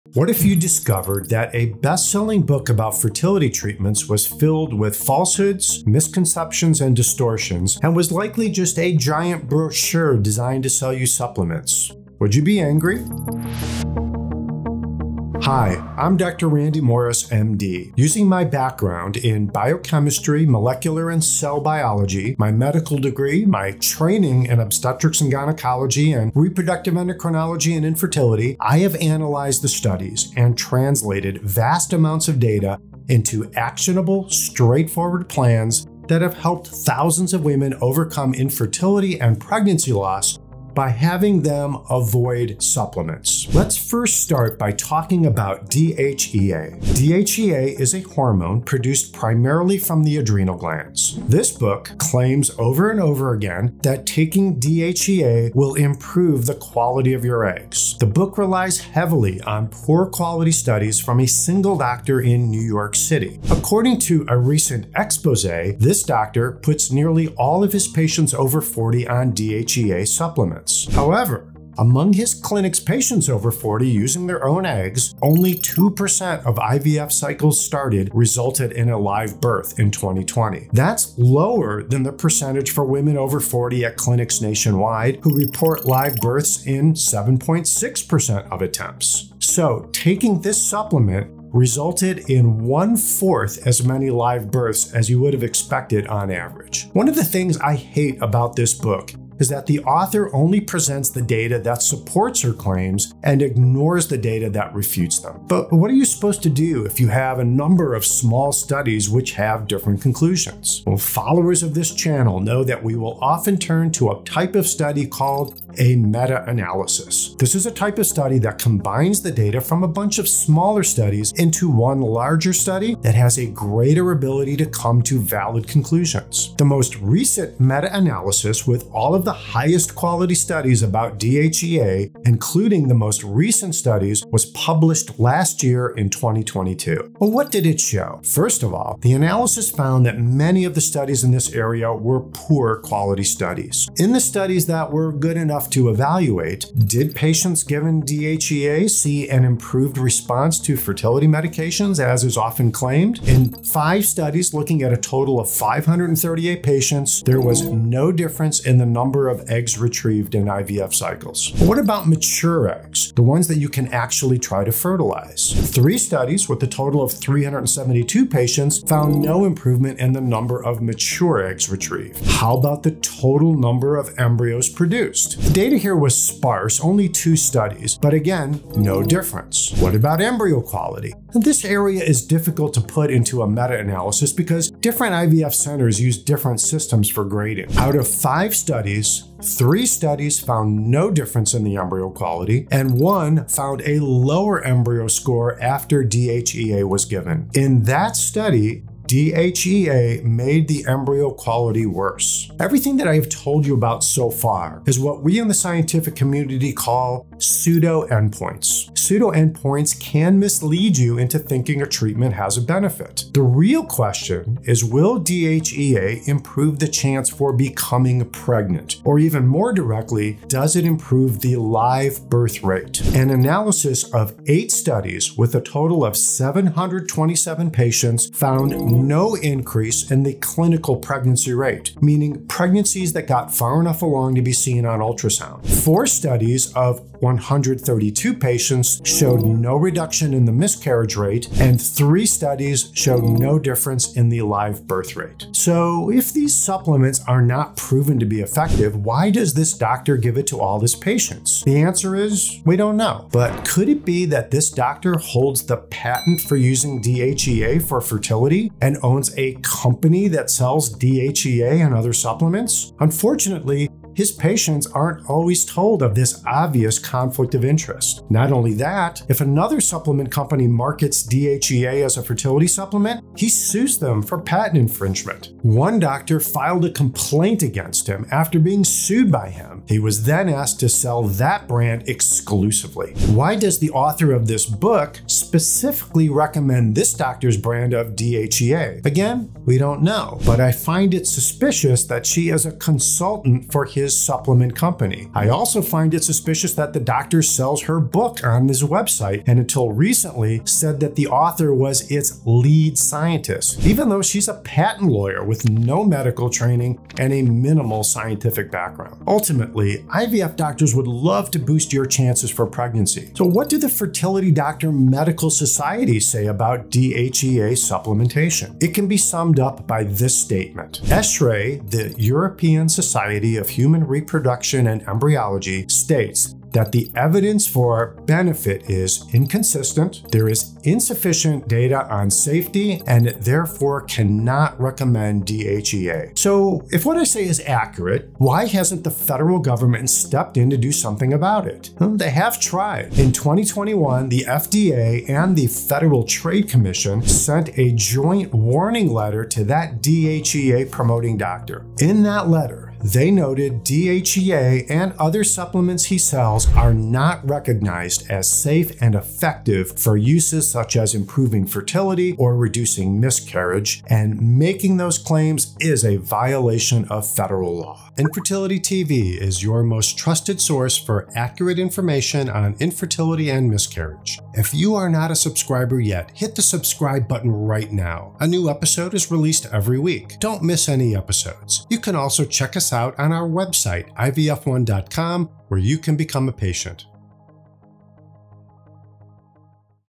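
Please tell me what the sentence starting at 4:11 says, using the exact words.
The answer is we don't know.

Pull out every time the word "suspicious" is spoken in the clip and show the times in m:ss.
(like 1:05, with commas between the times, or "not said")
4:51, 4:56.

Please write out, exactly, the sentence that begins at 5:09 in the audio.
Ultimately, IVF doctors would love to boost your chances for pregnancy.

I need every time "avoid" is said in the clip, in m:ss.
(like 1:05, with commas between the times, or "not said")
0:41.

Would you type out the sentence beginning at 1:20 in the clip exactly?
That's lower than the percentage for women over 40 at clinics nationwide who report live births in 7.6% of attempts.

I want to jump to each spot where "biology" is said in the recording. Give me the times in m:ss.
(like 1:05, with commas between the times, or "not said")
0:21.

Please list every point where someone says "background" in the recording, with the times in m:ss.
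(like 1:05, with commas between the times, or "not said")
0:18, 5:08.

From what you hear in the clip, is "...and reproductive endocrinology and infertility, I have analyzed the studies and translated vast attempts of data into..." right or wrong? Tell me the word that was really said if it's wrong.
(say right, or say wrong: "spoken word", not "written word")
wrong: "amounts", not "attempts".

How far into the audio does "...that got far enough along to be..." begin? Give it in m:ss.
3:53.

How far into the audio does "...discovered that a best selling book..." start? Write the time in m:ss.
0:00.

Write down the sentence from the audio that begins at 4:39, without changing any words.
He was then asked to sell that brand exclusively.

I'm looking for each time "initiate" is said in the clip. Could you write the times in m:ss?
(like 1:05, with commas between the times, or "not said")
not said.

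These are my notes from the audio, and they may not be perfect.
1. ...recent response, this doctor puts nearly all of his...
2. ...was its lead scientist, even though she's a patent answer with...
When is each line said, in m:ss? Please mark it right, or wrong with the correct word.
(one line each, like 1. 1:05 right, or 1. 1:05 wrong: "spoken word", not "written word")
1. 1:04 wrong: "expose", not "response"
2. 5:01 wrong: "lawyer", not "answer".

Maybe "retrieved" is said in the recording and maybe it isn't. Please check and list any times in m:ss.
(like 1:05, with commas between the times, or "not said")
2:39, 2:51.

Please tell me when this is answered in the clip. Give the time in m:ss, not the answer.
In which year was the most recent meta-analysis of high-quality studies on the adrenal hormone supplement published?
2:16.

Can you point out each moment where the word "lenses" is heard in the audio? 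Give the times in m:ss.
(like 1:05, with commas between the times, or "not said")
not said.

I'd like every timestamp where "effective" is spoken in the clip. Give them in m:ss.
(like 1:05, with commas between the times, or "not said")
4:08, 5:59.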